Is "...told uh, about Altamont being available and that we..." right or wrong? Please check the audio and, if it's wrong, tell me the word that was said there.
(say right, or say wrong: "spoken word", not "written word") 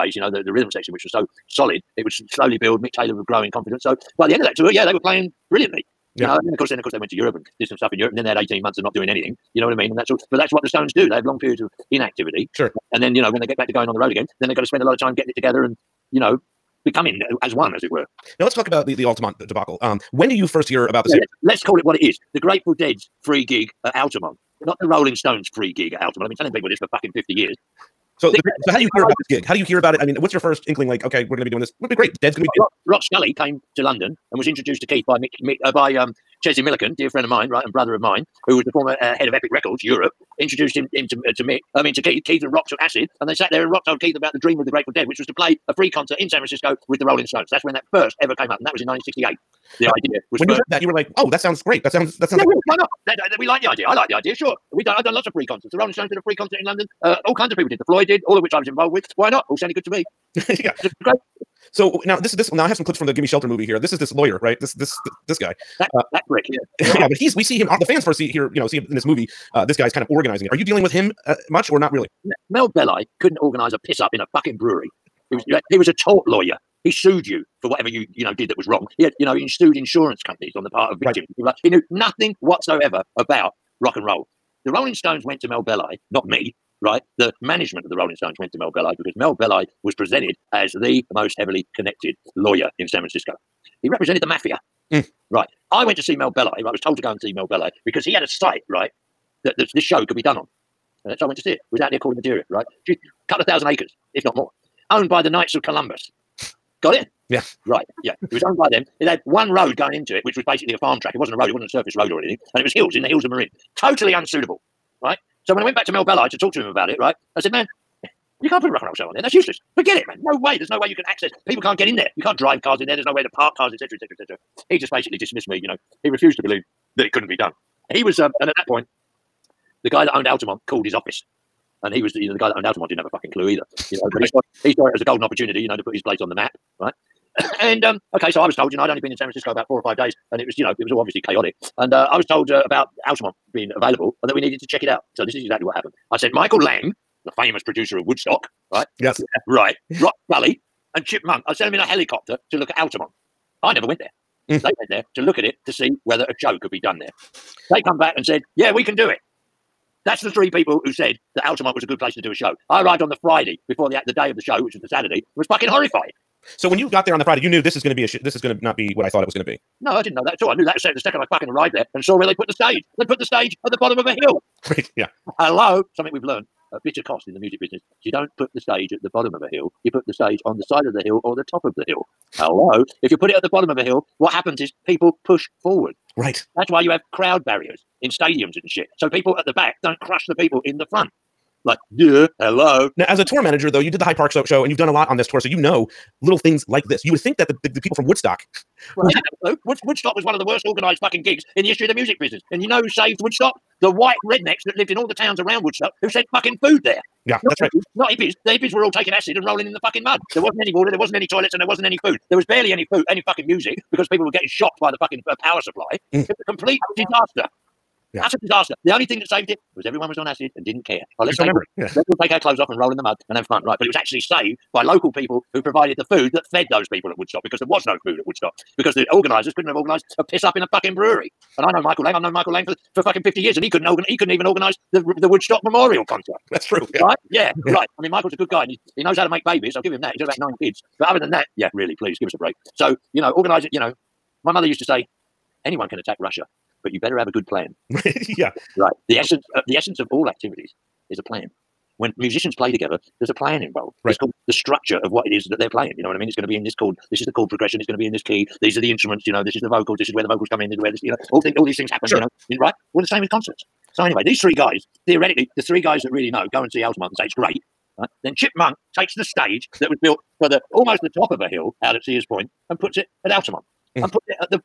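right.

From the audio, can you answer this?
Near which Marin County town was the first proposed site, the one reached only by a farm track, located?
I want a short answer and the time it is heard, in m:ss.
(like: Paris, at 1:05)
Corte Madera, at 1:41.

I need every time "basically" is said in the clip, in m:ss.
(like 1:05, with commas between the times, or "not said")
1:50, 2:04.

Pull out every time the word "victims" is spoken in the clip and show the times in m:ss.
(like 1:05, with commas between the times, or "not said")
1:20.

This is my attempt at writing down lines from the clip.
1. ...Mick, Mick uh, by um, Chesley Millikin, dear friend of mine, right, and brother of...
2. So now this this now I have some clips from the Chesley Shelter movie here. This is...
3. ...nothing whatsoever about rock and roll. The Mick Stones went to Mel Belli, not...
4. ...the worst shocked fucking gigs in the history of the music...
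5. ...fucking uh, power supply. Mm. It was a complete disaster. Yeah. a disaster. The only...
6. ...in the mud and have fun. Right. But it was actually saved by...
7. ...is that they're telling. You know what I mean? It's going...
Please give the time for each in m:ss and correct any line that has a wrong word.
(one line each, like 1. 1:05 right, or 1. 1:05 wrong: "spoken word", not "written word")
1. 0:35 right
2. 1:01 wrong: "Gimme", not "Chesley"
3. 1:21 wrong: "Rolling", not "Mick"
4. 3:20 wrong: "organized", not "shocked"
5. 3:35 right
6. 3:42 right
7. 4:15 wrong: "playing", not "telling".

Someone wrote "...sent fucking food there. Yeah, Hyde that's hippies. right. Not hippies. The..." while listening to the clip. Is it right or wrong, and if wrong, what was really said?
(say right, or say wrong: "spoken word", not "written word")
wrong: "Not", not "Hyde".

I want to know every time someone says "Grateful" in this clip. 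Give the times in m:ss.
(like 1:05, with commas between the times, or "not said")
0:22, 0:44.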